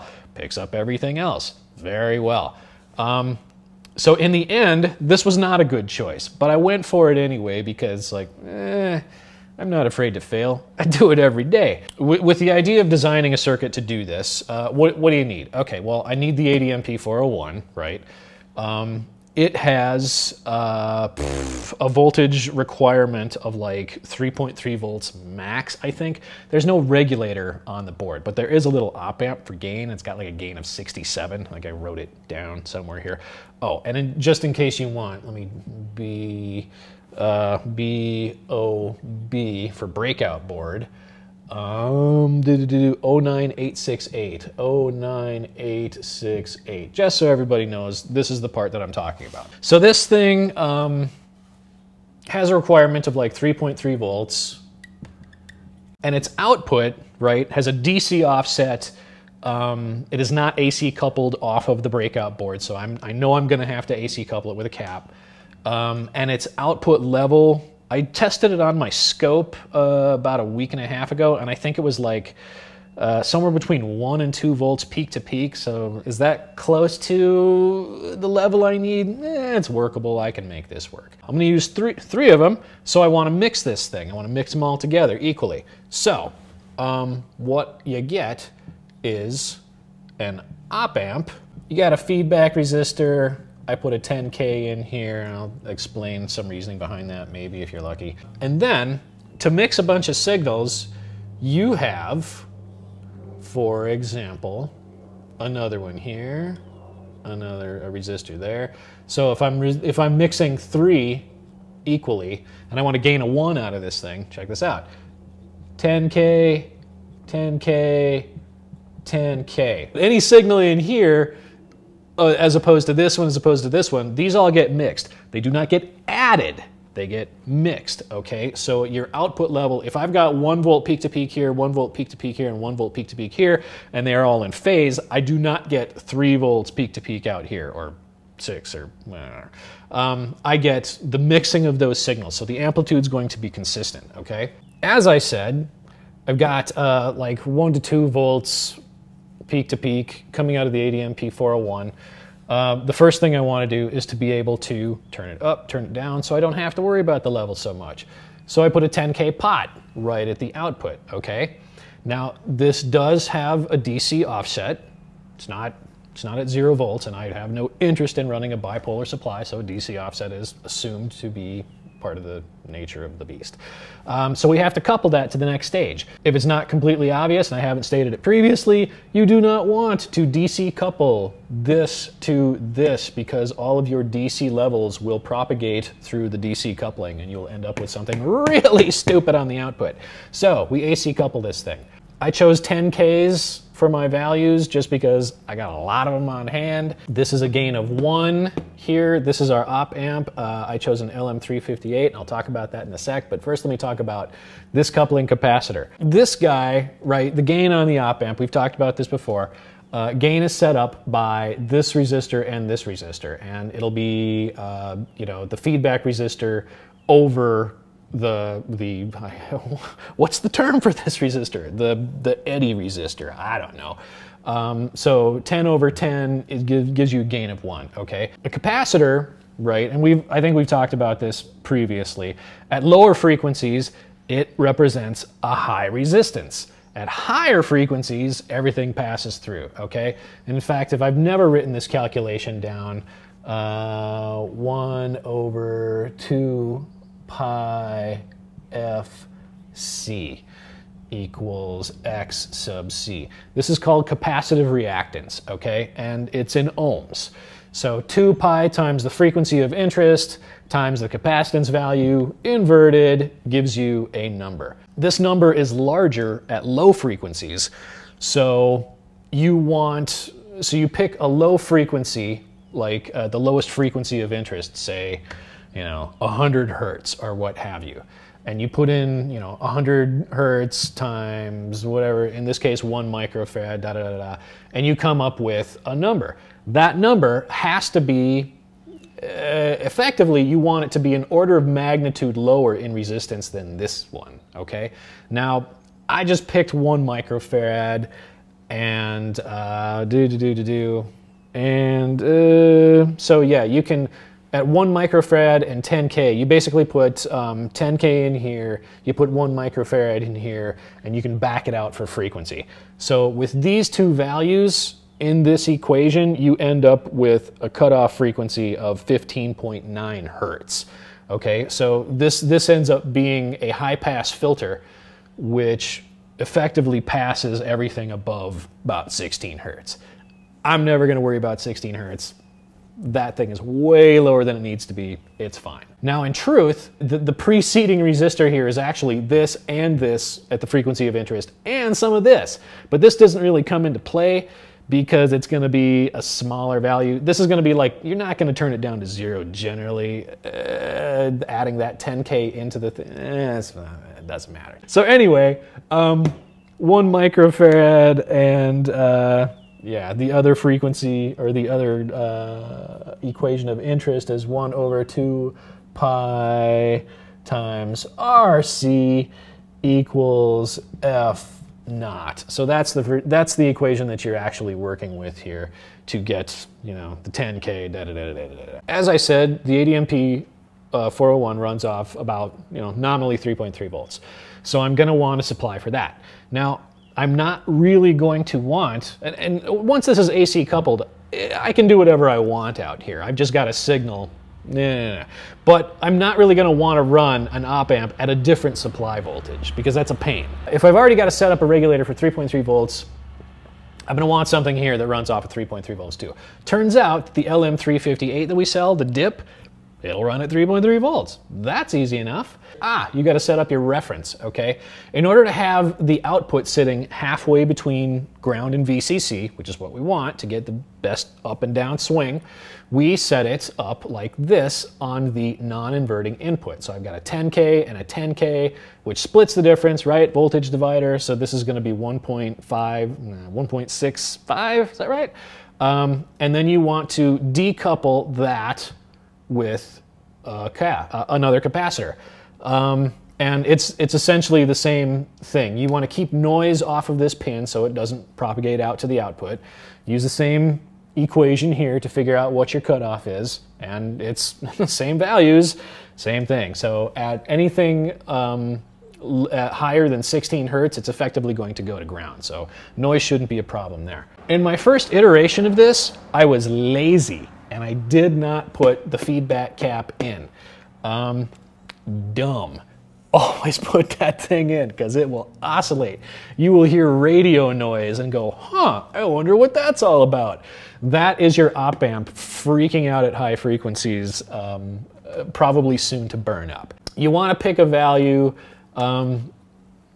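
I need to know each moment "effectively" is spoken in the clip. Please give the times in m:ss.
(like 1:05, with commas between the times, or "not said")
4:49, 5:26, 7:41.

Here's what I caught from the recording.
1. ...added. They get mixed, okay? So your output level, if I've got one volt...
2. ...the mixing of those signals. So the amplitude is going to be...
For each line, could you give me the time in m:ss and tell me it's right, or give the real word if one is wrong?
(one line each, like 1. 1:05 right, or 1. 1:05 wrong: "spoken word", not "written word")
1. 2:06 right
2. 2:21 right.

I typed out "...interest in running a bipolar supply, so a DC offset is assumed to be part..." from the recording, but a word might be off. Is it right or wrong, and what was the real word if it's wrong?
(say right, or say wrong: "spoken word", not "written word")
right.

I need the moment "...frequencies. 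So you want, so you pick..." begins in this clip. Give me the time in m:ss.
4:26.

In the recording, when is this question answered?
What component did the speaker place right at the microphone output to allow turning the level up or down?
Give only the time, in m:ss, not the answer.
2:38.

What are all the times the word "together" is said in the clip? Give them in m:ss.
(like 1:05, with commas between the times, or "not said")
1:24.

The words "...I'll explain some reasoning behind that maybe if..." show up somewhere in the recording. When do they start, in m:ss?
1:35.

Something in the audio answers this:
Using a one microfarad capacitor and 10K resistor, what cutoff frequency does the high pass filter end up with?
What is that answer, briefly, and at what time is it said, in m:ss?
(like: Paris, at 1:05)
15.9 hertz, at 5:19.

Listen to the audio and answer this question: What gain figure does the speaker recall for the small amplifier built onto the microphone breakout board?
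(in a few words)
67.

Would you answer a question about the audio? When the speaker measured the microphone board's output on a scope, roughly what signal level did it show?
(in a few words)
1 to 2 volts peak to peak.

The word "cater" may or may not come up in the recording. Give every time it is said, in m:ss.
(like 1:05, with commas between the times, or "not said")
not said.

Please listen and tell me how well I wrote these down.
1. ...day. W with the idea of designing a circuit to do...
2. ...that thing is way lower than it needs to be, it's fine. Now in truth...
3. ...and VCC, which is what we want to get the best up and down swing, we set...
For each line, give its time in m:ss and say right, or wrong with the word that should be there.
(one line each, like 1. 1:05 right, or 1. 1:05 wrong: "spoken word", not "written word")
1. 0:11 right
2. 5:32 right
3. 6:58 right.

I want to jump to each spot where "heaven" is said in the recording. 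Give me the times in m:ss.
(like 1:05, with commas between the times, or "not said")
not said.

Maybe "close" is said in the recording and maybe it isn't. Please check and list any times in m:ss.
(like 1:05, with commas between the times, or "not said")
1:16.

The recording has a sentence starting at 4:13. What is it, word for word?
This is called capacitive reactance, okay?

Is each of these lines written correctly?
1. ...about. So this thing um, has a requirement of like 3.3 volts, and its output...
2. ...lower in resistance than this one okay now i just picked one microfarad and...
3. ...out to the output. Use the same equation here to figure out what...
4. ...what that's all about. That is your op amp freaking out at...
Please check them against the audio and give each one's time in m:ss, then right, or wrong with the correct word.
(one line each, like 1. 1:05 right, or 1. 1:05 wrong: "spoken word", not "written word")
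1. 0:49 right
2. 4:52 right
3. 7:28 right
4. 7:59 right.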